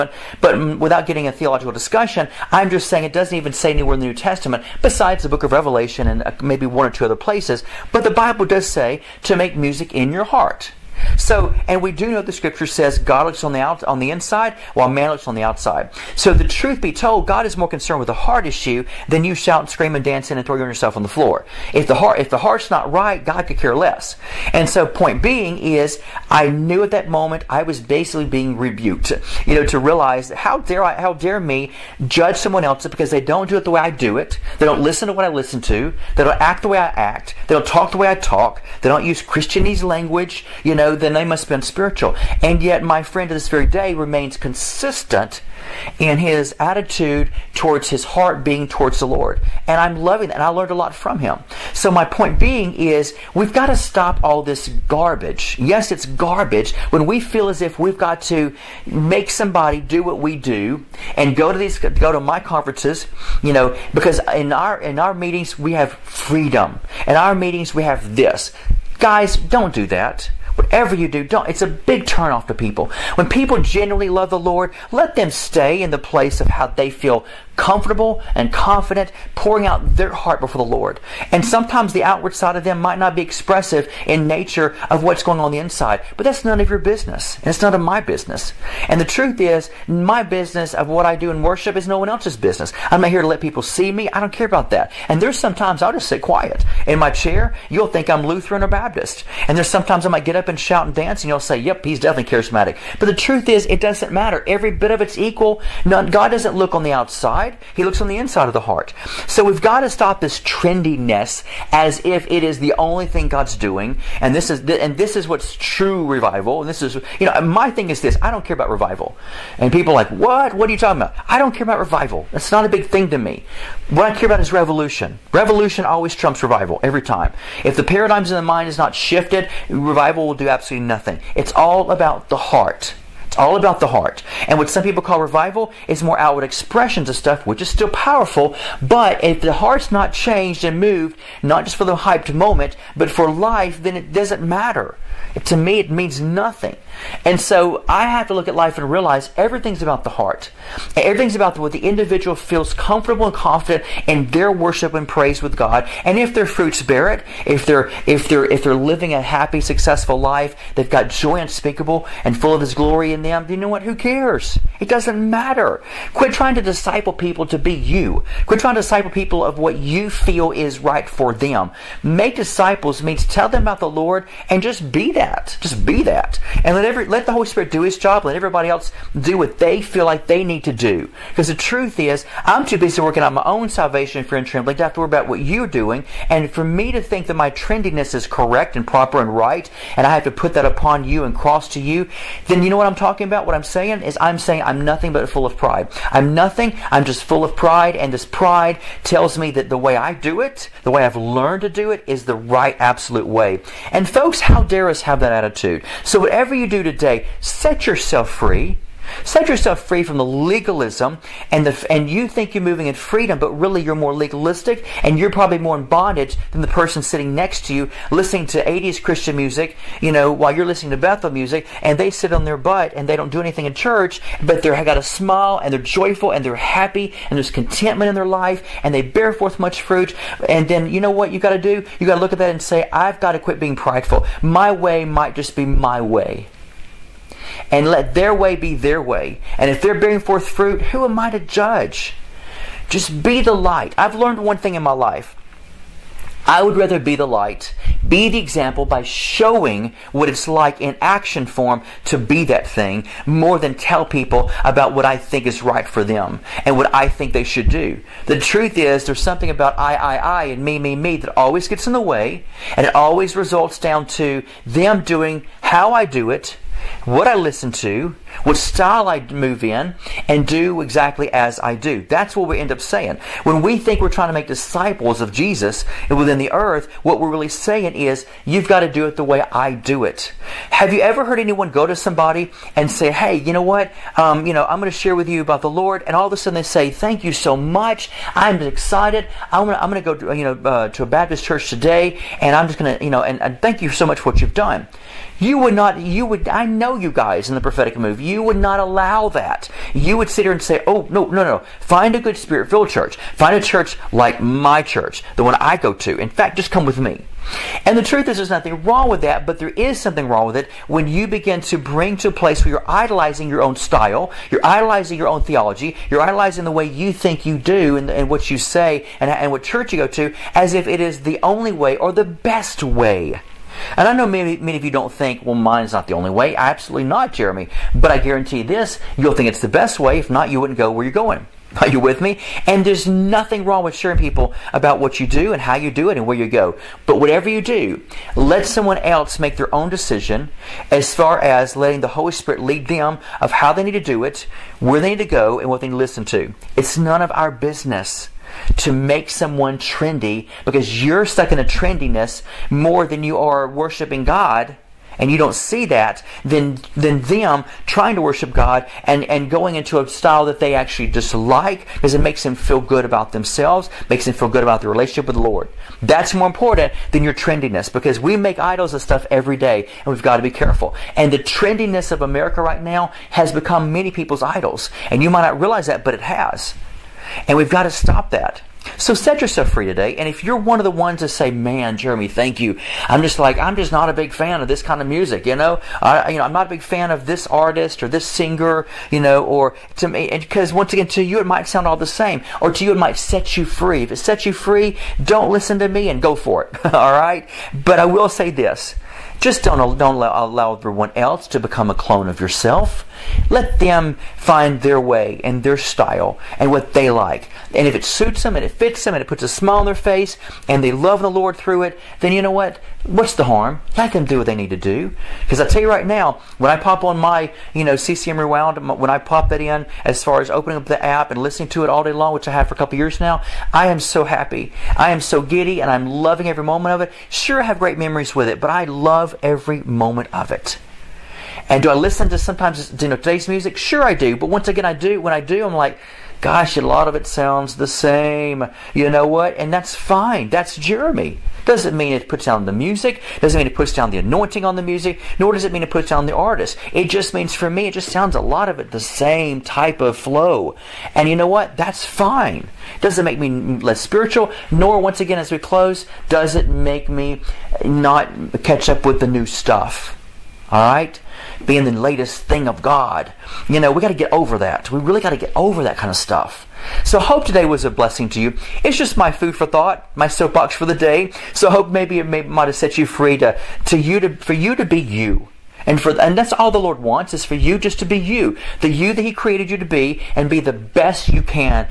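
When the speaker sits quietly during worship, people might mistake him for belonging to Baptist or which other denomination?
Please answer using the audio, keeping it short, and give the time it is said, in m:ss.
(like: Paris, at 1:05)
Lutheran, at 1:38.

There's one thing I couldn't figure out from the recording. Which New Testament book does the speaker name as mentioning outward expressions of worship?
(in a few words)
Revelation.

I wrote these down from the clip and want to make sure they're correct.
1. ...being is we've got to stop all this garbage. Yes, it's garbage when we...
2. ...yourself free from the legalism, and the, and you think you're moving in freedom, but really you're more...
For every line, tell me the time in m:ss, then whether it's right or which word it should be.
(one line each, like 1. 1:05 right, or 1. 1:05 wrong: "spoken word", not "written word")
1. 0:52 right
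2. 3:29 right.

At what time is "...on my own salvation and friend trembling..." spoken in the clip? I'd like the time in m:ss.
3:03.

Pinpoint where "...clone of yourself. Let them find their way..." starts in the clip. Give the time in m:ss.
6:41.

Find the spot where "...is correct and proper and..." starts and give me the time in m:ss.
3:08.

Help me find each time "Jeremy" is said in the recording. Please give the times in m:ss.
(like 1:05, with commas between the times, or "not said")
5:27, 6:21, 7:20.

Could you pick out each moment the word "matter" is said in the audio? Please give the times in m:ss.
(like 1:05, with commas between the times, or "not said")
1:44, 2:24, 2:45.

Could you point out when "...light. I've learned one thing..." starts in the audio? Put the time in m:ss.
4:03.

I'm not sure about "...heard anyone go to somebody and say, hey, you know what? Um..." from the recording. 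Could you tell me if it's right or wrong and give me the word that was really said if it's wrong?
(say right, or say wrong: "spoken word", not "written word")
right.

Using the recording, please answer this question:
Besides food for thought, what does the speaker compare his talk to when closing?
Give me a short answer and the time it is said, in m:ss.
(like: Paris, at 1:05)
Soapbox, at 7:50.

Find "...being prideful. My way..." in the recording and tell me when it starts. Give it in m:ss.
3:53.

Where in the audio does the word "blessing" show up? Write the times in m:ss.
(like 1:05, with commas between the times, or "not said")
7:47.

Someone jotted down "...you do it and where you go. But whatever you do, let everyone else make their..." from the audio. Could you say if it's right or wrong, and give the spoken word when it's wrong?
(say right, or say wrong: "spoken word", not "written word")
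wrong: "someone", not "everyone".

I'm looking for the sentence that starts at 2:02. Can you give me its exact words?
That's not a big thing to me.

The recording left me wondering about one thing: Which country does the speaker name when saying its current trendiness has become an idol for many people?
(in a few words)
America.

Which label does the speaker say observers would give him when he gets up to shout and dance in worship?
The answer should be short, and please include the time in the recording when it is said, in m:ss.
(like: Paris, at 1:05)
Charismatic, at 1:42.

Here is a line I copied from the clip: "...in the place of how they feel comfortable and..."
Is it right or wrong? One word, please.
right.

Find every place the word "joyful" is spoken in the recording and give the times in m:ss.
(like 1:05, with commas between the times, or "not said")
3:45.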